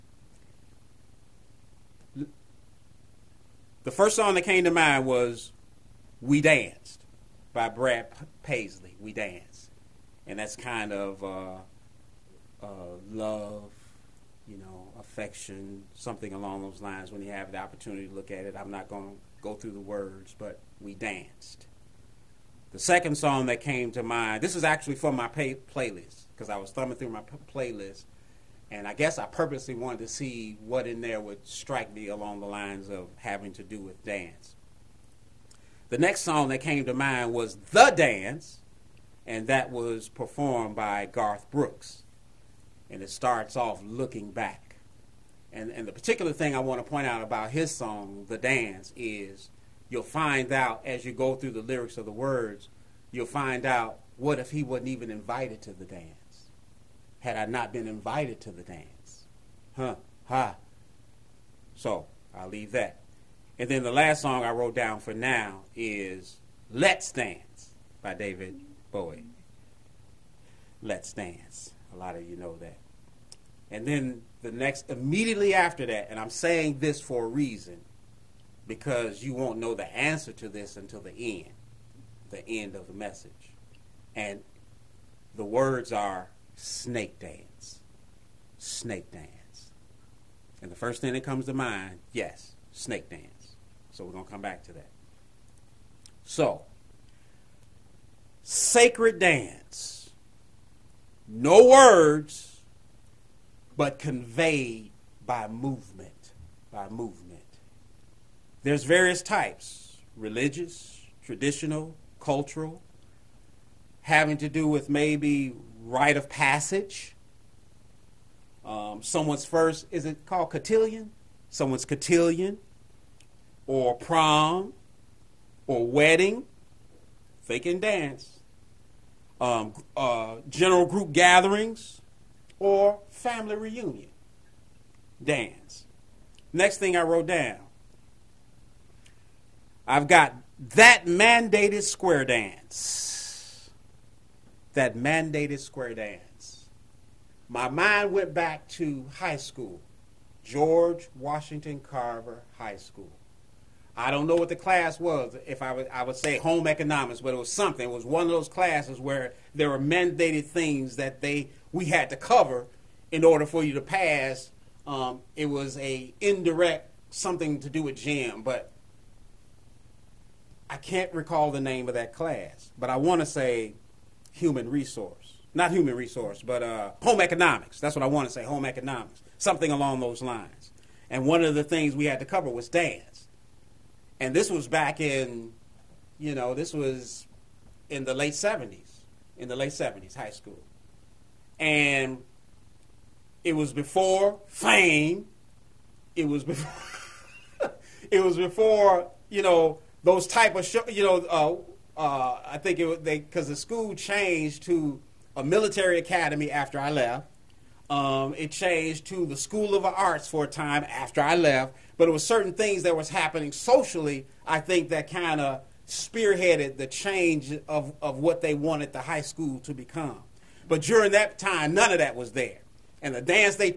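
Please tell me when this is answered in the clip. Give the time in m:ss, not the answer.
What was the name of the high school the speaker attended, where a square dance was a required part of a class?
2:30.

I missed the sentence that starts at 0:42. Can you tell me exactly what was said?
And it starts off looking back.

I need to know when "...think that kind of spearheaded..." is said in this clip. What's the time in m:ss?
3:34.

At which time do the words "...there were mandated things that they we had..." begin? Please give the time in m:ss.
2:39.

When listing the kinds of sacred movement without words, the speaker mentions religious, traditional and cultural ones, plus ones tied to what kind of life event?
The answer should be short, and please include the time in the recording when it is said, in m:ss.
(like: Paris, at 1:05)
Rite of passage, at 1:55.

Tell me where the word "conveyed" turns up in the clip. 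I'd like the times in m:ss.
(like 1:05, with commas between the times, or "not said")
1:43.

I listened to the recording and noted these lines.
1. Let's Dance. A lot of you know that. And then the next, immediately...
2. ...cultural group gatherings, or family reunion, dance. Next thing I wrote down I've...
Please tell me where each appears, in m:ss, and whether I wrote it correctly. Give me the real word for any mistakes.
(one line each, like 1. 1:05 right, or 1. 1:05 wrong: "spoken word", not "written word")
1. 1:10 right
2. 2:10 wrong: "general", not "cultural".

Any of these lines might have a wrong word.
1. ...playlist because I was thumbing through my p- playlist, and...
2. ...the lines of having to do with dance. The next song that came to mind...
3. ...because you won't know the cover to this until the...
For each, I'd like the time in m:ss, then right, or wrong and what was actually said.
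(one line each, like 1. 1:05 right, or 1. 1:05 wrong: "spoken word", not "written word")
1. 0:25 right
2. 0:32 right
3. 1:18 wrong: "answer", not "cover".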